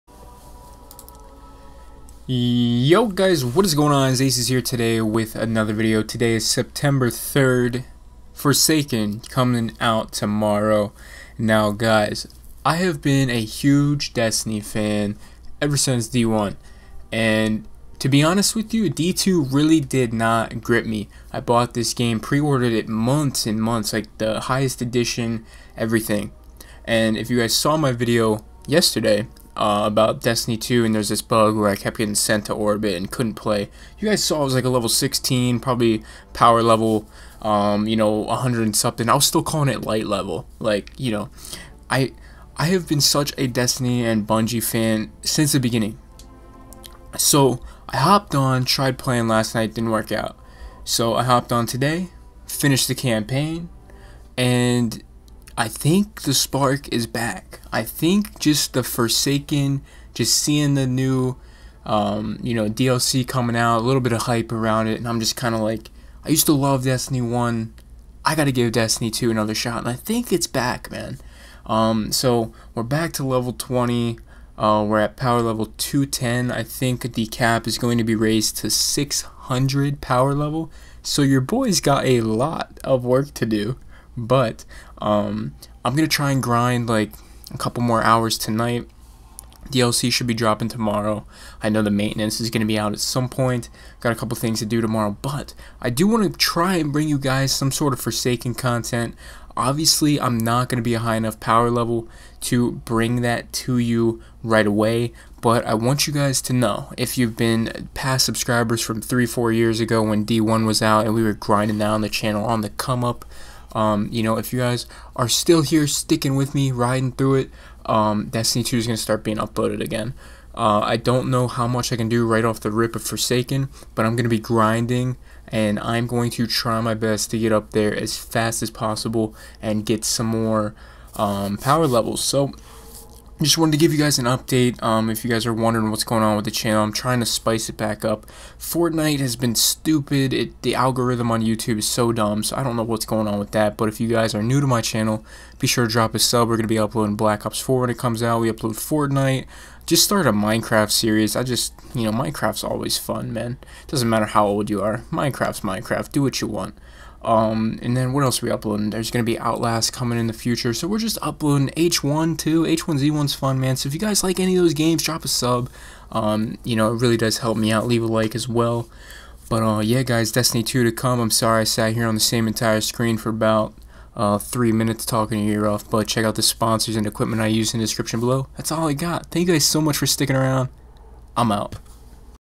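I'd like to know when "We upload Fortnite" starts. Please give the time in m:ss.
2:28.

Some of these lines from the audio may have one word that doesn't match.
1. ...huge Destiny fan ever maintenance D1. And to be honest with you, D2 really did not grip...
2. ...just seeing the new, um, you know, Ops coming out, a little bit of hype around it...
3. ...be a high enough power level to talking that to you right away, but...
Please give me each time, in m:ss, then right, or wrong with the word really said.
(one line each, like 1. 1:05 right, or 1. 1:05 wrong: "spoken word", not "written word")
1. 0:13 wrong: "since", not "maintenance"
2. 1:00 wrong: "DLC", not "Ops"
3. 1:40 wrong: "bring", not "talking".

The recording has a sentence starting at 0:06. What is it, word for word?
Today is September 3rd, Forsaken coming out tomorrow.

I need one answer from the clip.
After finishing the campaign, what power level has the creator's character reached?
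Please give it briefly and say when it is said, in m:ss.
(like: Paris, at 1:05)
210, at 1:15.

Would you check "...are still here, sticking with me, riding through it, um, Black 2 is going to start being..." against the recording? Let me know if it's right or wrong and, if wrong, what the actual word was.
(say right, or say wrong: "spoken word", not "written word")
wrong: "Destiny", not "Black".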